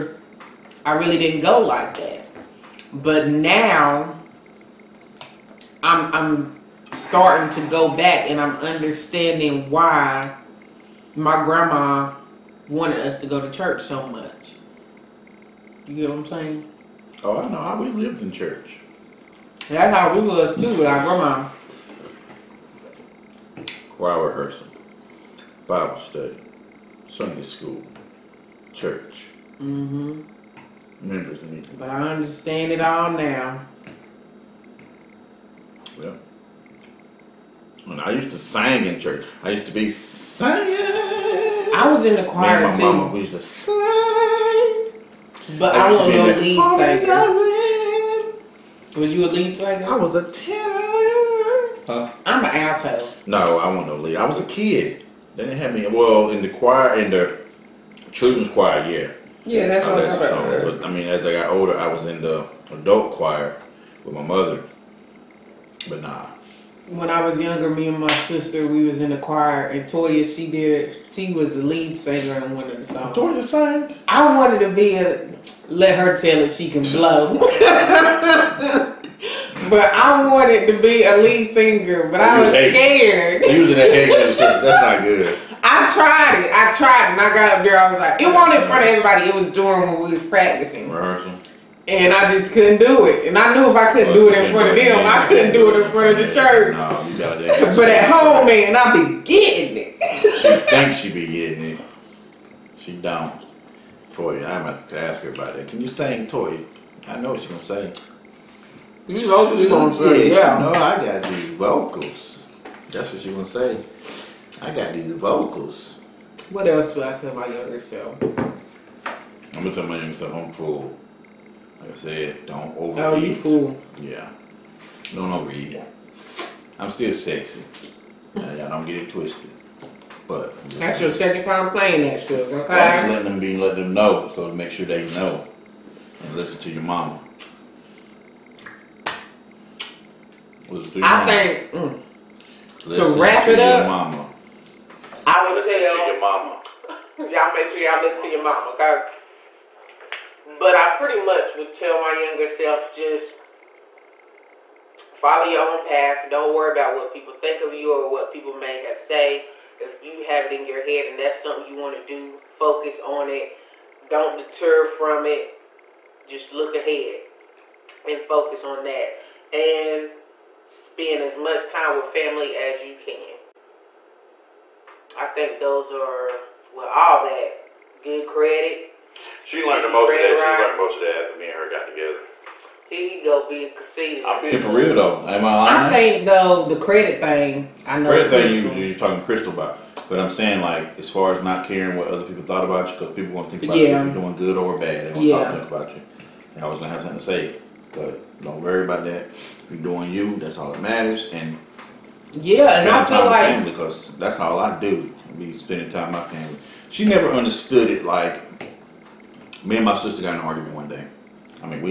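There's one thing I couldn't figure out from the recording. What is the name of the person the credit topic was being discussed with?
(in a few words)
Crystal.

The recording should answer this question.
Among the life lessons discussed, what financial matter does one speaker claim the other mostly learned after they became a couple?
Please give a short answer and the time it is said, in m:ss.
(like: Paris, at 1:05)
Good credit, at 2:58.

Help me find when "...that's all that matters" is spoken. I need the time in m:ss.
3:20.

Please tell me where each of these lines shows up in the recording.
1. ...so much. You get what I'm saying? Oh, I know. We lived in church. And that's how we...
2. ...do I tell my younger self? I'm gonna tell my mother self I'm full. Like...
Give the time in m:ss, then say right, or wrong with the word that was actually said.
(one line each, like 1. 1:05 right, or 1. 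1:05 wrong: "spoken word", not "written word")
1. 0:13 right
2. 1:56 wrong: "younger", not "mother".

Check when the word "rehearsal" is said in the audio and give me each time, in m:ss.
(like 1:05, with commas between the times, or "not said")
0:24, 1:30.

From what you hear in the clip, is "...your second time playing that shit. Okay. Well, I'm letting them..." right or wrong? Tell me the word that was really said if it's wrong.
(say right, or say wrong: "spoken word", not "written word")
right.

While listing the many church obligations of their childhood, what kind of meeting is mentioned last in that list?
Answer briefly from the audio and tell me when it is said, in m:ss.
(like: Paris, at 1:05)
Members meeting, at 0:31.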